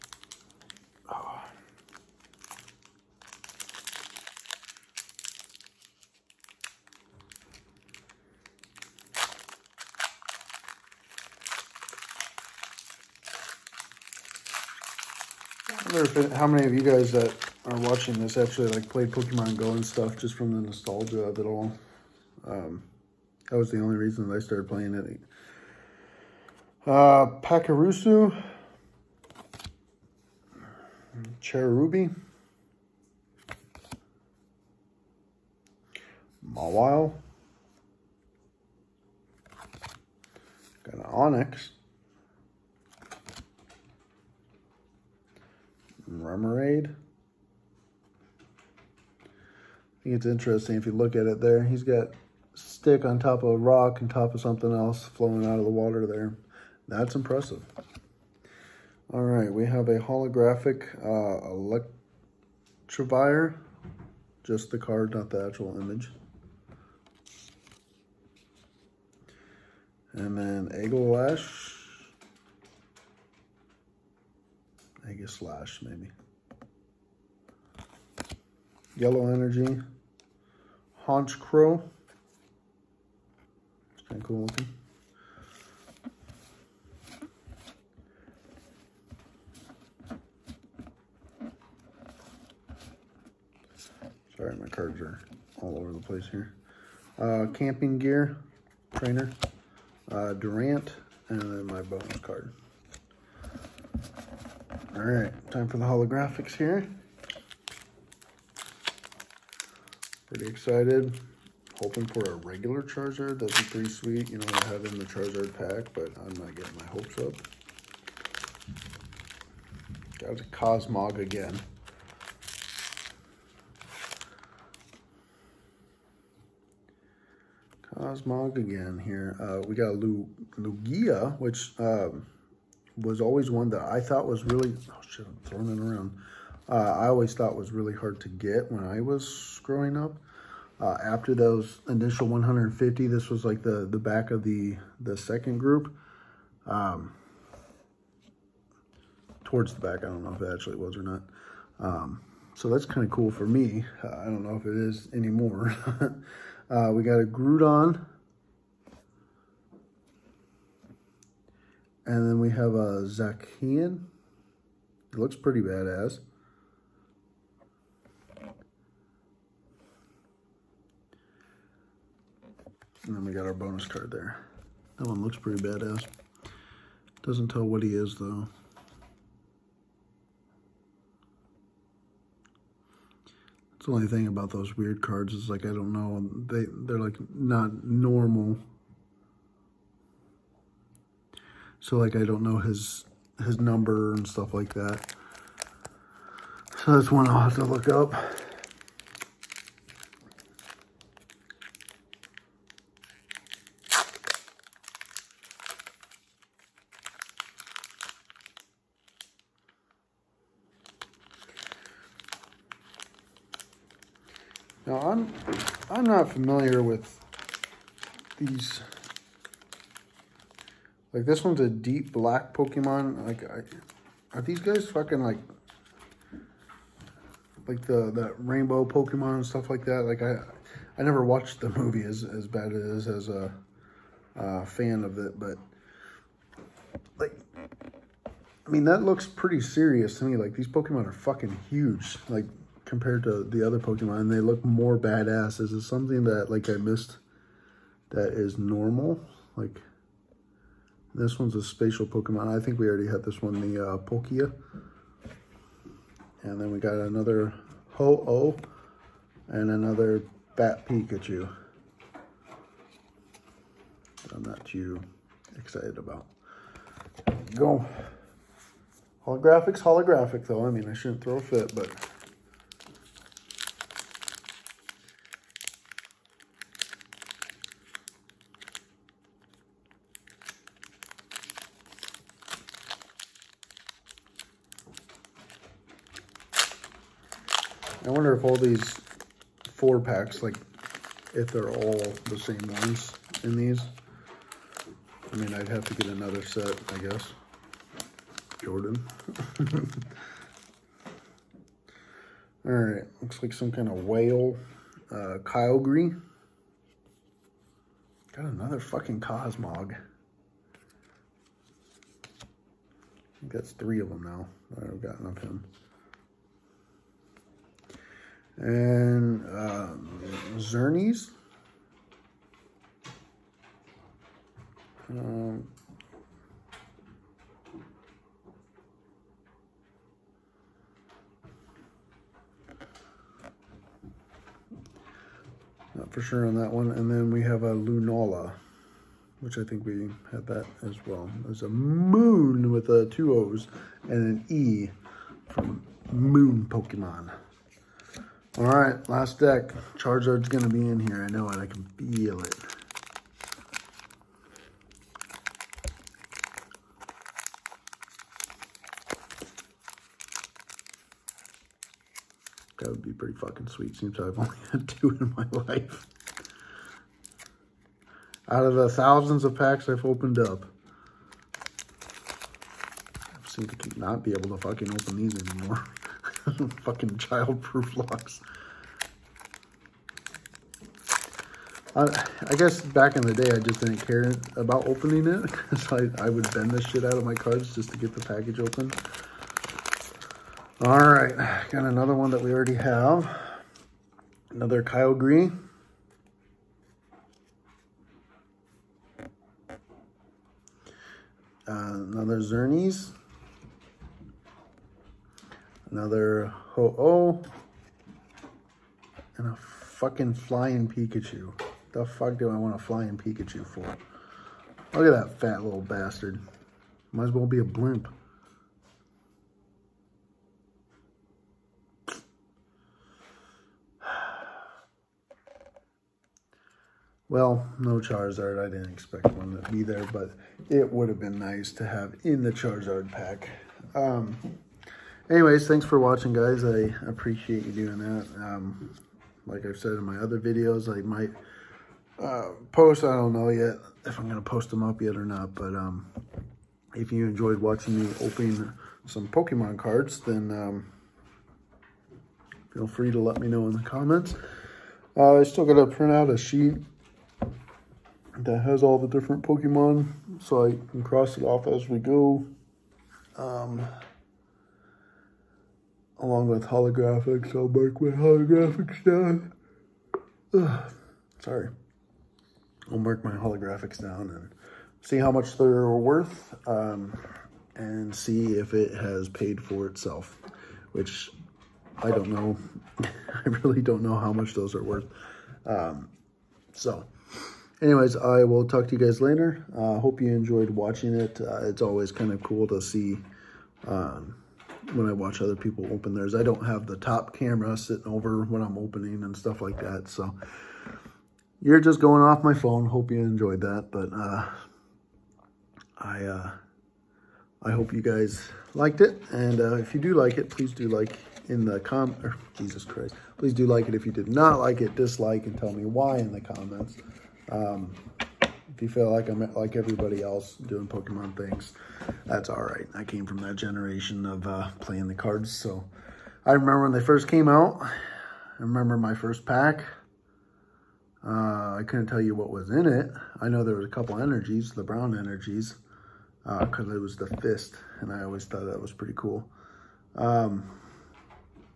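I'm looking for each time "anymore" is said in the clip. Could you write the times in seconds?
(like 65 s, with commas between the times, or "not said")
155 s, 375 s.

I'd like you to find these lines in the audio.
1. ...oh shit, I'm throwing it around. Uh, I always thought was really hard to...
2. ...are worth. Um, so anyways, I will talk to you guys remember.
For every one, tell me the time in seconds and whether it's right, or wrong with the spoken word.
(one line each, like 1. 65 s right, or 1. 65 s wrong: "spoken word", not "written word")
1. 134 s right
2. 484 s wrong: "later", not "remember".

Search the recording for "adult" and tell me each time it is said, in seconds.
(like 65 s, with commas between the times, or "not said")
not said.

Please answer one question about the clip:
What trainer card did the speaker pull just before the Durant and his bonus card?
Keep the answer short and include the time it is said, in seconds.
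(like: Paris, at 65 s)
Camping gear, at 97 s.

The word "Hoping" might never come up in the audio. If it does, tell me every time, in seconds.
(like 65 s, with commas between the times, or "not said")
111 s.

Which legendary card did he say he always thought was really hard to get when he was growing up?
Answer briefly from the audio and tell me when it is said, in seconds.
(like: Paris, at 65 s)
Lugia, at 129 s.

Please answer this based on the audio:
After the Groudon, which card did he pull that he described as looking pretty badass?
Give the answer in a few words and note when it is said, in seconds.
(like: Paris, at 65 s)
Zacian, at 163 s.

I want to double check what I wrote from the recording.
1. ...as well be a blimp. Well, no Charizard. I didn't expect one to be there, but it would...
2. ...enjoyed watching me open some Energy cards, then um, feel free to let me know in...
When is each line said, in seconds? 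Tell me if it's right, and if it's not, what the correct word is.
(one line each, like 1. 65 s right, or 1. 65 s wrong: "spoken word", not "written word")
1. 417 s right
2. 447 s wrong: "Pokemon", not "Energy".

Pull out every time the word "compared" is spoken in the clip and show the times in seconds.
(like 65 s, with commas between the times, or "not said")
242 s.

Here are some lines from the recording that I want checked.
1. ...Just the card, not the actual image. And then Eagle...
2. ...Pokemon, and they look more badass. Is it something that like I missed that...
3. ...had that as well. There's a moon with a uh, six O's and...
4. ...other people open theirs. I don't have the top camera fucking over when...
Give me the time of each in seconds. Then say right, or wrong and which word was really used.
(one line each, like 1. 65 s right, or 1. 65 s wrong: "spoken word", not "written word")
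1. 64 s right
2. 243 s right
3. 340 s wrong: "two", not "six"
4. 495 s wrong: "sitting", not "fucking".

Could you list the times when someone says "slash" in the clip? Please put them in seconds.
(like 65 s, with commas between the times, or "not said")
75 s.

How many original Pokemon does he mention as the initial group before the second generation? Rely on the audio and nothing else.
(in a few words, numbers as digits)
150.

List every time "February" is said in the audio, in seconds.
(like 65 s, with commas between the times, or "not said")
not said.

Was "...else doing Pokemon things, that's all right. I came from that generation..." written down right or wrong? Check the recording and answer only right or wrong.
right.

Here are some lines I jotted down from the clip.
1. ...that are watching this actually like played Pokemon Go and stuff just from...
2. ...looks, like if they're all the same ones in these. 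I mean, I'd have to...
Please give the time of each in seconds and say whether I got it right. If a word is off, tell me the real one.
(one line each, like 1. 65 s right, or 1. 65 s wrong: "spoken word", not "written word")
1. 17 s right
2. 289 s wrong: "packs", not "looks".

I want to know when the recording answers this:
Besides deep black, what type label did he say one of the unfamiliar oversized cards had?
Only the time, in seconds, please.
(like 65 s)
251 s.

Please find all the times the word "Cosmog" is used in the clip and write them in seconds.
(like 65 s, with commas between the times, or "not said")
120 s, 127 s, 309 s.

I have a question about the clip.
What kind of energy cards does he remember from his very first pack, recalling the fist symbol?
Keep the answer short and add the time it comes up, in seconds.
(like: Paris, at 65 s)
Brown energies, at 534 s.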